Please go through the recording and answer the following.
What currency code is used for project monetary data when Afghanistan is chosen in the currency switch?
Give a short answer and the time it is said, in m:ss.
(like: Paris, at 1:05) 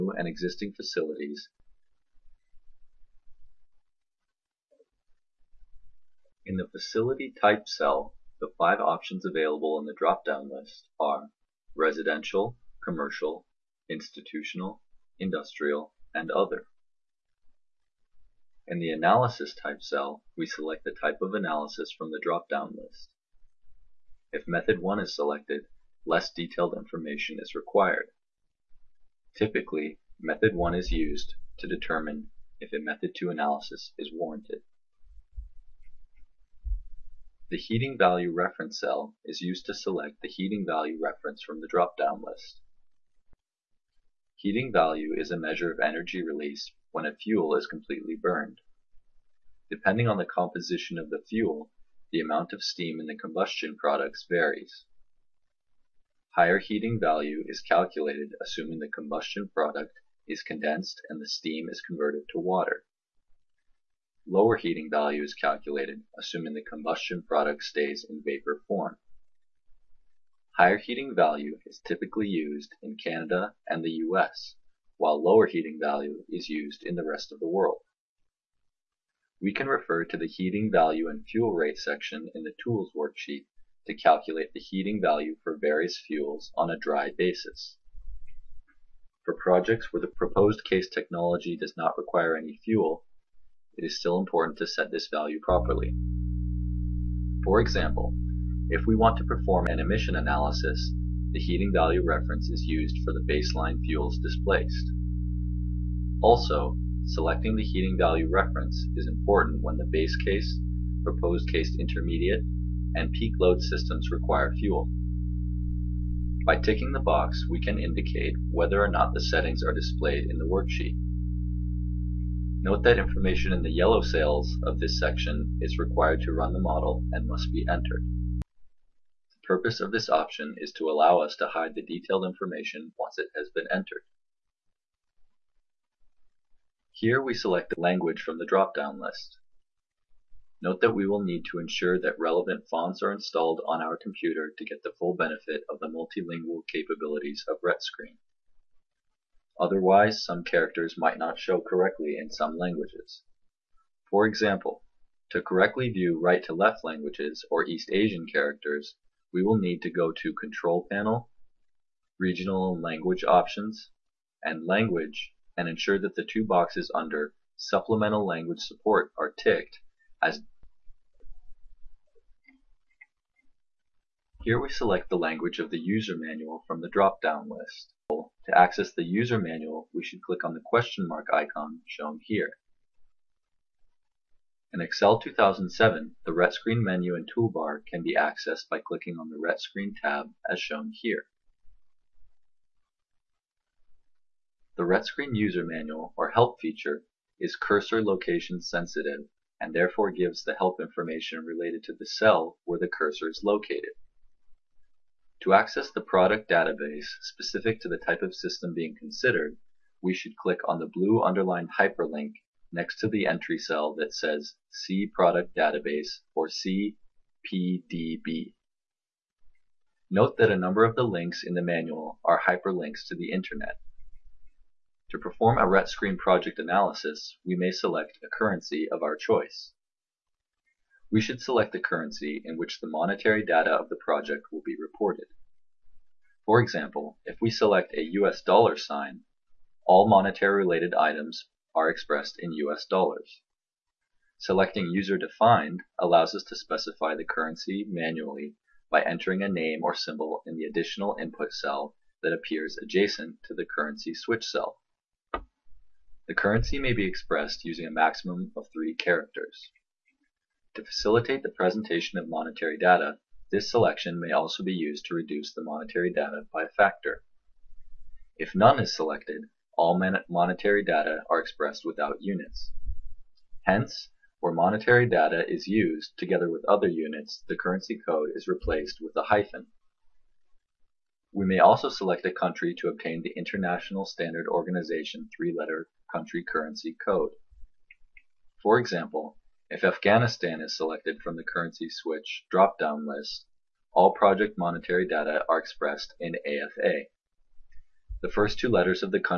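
AFA, at 4:56.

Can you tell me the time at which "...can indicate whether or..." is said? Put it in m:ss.
1:57.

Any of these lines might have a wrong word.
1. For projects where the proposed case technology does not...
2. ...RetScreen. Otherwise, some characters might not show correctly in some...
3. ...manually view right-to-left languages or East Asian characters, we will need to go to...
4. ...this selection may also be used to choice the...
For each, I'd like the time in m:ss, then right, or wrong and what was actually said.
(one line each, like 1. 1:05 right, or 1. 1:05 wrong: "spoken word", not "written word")
1. 1:29 right
2. 2:27 right
3. 2:35 wrong: "correctly", not "manually"
4. 4:23 wrong: "reduce", not "choice".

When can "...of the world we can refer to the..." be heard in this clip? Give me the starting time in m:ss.
1:17.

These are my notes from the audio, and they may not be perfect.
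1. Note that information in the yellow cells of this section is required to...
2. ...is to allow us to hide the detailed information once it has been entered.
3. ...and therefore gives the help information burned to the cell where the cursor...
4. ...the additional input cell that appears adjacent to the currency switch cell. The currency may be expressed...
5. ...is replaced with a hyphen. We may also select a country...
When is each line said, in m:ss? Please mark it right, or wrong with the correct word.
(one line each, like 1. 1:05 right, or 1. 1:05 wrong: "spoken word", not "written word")
1. 2:02 right
2. 2:10 right
3. 3:19 wrong: "related", not "burned"
4. 4:10 right
5. 4:38 right.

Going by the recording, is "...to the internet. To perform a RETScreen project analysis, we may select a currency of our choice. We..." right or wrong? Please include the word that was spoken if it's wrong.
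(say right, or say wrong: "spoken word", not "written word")
right.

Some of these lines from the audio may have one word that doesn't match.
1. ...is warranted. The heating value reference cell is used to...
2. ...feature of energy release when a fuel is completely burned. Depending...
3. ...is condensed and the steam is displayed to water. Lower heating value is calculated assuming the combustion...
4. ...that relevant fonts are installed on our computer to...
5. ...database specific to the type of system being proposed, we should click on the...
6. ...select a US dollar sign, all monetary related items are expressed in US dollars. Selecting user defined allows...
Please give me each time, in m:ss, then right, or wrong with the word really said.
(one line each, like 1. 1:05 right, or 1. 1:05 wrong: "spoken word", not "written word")
1. 0:33 right
2. 0:45 wrong: "measure", not "feature"
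3. 1:00 wrong: "converted", not "displayed"
4. 2:21 right
5. 3:26 wrong: "considered", not "proposed"
6. 3:57 right.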